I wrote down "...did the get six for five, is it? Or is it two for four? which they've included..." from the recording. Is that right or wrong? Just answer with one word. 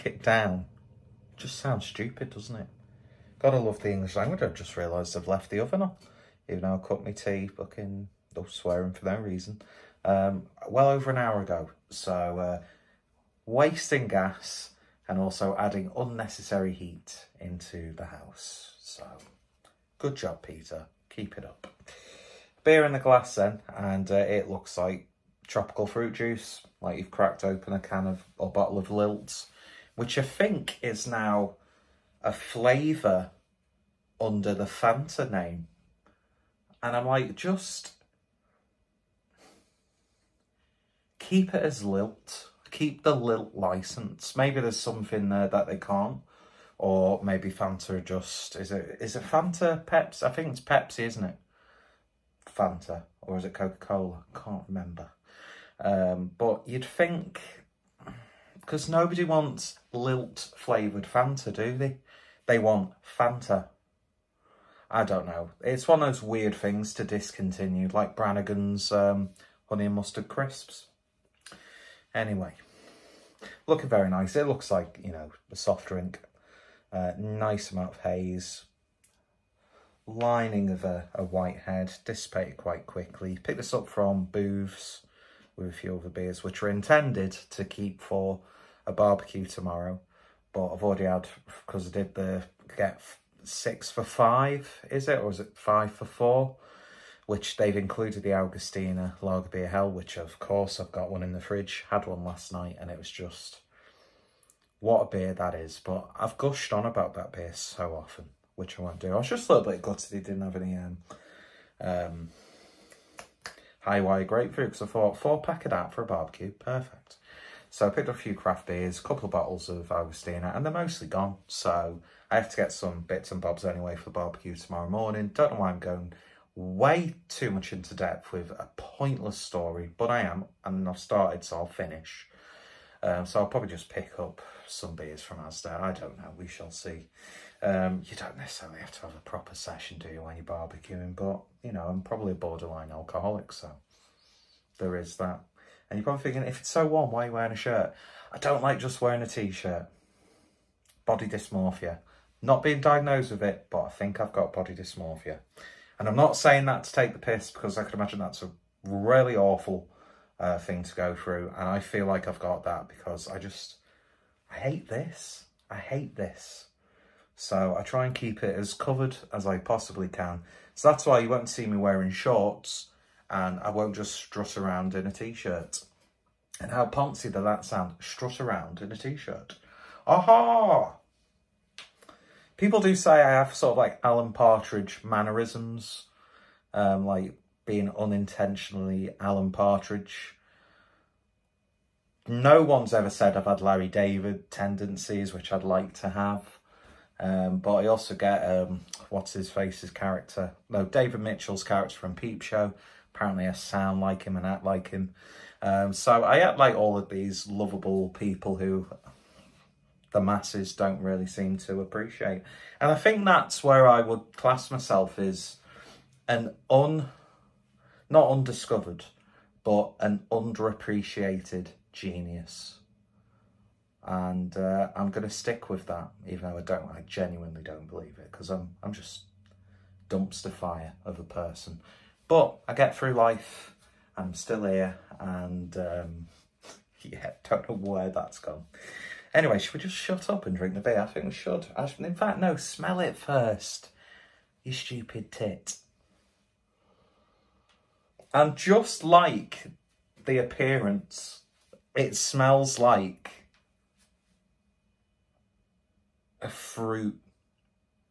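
wrong.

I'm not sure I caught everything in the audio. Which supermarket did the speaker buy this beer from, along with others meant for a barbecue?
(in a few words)
Booths.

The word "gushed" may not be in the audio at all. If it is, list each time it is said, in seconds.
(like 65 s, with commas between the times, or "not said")
106 s.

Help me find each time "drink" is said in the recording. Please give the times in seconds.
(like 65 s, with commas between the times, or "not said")
75 s, 240 s.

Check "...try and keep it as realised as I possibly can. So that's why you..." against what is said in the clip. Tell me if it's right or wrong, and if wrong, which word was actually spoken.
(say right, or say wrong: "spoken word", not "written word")
wrong: "covered", not "realised".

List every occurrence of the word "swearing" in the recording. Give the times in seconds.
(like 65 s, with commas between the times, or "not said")
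8 s.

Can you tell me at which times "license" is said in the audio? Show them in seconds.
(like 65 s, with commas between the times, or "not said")
43 s.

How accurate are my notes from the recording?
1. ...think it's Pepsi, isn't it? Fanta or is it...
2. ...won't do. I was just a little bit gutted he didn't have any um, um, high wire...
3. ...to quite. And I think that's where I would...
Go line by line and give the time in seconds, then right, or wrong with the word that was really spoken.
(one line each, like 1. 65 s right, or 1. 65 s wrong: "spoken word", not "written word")
1. 50 s right
2. 108 s right
3. 211 s wrong: "appreciate", not "quite".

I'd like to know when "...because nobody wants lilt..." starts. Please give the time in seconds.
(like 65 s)
58 s.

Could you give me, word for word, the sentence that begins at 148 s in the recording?
I don't like just wearing a t-shirt.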